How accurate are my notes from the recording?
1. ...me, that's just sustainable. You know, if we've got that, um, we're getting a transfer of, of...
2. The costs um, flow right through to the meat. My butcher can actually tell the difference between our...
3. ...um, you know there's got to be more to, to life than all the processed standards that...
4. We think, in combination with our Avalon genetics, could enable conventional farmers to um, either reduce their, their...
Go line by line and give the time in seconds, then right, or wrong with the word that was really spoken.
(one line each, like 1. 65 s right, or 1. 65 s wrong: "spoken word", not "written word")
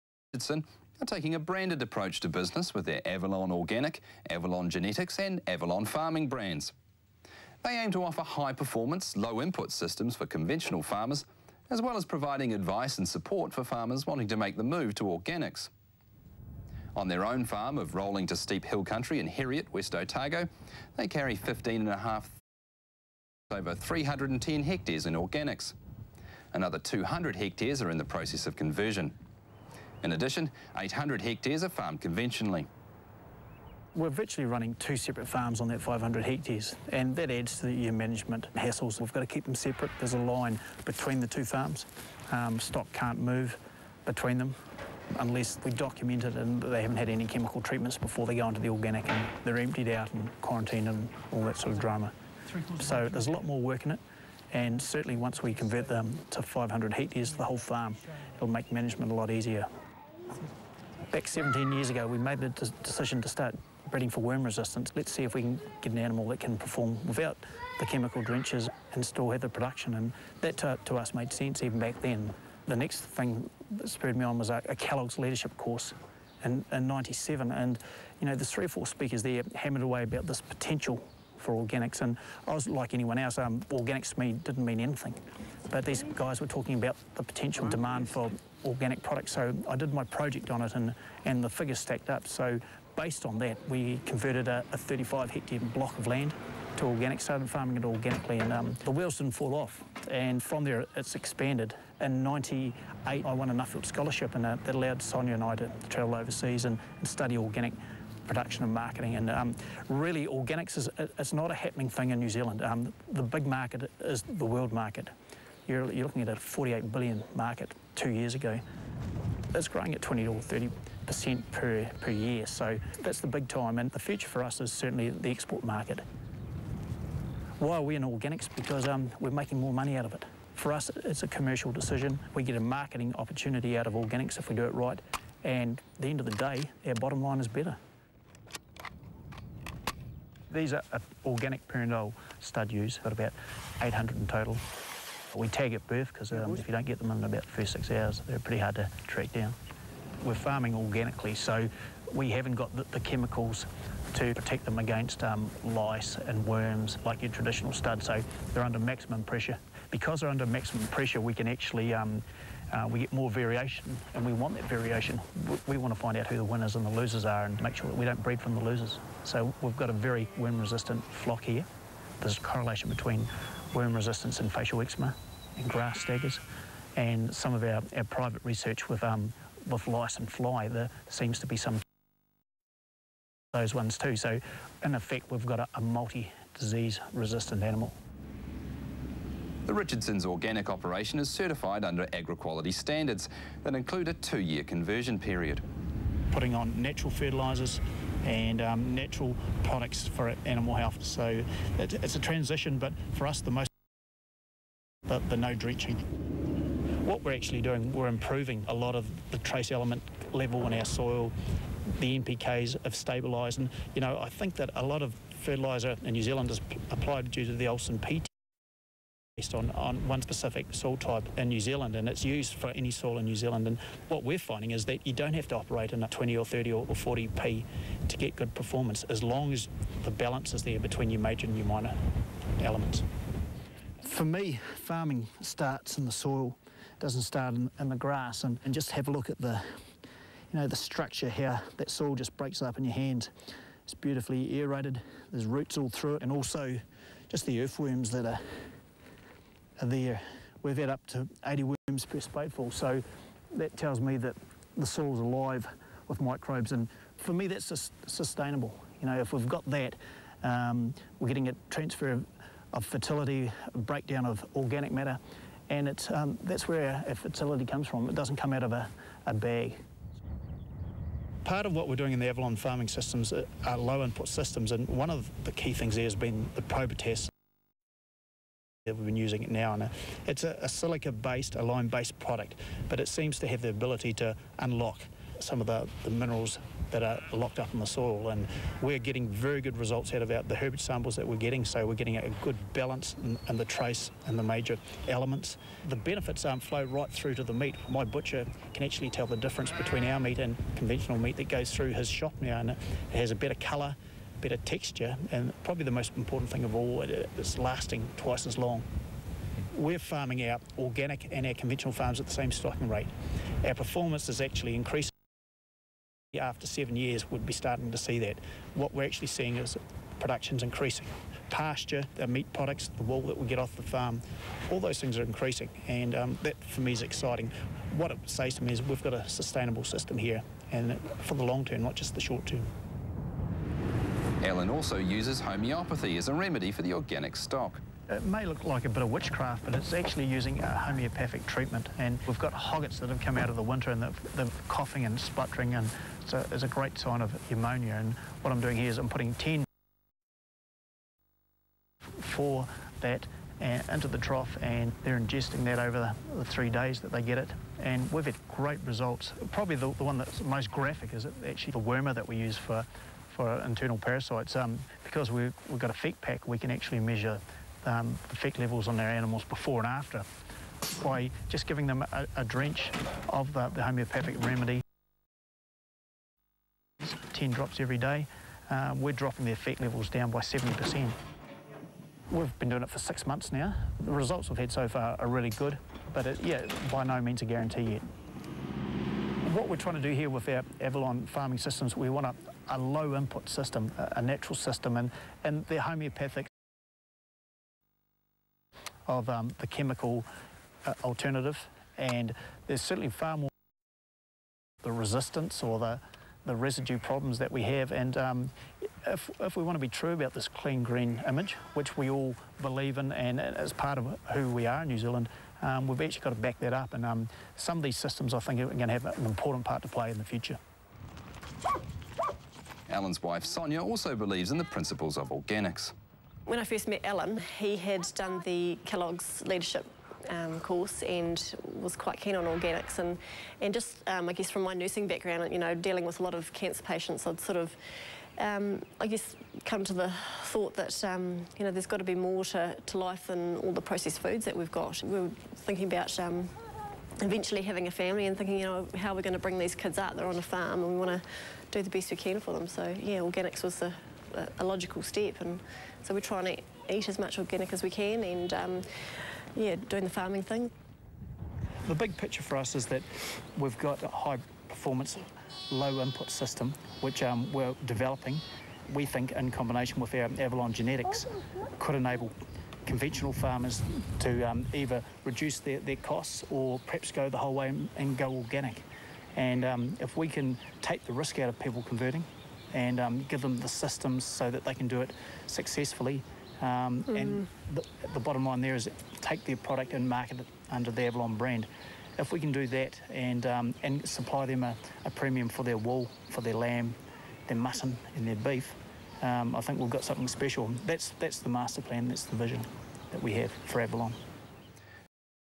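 1. 257 s right
2. 295 s wrong: "benefits", not "costs"
3. 441 s wrong: "foods", not "standards"
4. 468 s right.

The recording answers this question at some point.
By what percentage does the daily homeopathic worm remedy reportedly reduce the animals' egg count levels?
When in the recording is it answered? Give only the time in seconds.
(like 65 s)
380 s.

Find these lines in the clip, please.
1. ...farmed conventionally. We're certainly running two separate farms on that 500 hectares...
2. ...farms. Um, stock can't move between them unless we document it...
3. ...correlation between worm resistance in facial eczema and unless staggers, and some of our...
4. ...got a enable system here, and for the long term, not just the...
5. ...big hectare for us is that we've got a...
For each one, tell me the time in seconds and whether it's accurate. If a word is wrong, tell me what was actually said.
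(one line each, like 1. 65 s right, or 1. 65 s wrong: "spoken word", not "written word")
1. 31 s wrong: "virtually", not "certainly"
2. 41 s right
3. 172 s wrong: "grass", not "unless"
4. 329 s wrong: "sustainable", not "enable"
5. 461 s wrong: "picture", not "hectare".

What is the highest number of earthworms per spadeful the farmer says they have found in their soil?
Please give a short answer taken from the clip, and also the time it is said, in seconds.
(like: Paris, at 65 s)
80, at 251 s.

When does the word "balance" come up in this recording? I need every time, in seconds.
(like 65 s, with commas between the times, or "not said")
230 s, 292 s.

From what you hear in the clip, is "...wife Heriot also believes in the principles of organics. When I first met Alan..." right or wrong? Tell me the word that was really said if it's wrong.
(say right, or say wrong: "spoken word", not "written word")
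wrong: "Sonia", not "Heriot".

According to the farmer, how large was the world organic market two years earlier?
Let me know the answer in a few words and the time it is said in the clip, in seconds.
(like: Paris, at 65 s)
48 billion, at 116 s.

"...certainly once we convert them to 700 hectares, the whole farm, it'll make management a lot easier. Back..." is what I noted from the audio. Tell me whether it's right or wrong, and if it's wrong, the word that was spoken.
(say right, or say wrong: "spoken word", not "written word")
wrong: "500", not "700".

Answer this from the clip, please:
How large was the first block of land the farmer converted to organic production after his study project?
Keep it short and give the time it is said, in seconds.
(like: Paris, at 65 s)
35 hectares, at 94 s.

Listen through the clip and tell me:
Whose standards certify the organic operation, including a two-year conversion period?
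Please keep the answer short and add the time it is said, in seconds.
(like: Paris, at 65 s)
AgriQuality, at 192 s.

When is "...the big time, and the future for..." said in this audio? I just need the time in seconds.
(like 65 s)
123 s.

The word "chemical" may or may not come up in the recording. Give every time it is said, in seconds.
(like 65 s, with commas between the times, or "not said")
47 s, 67 s, 152 s, 399 s.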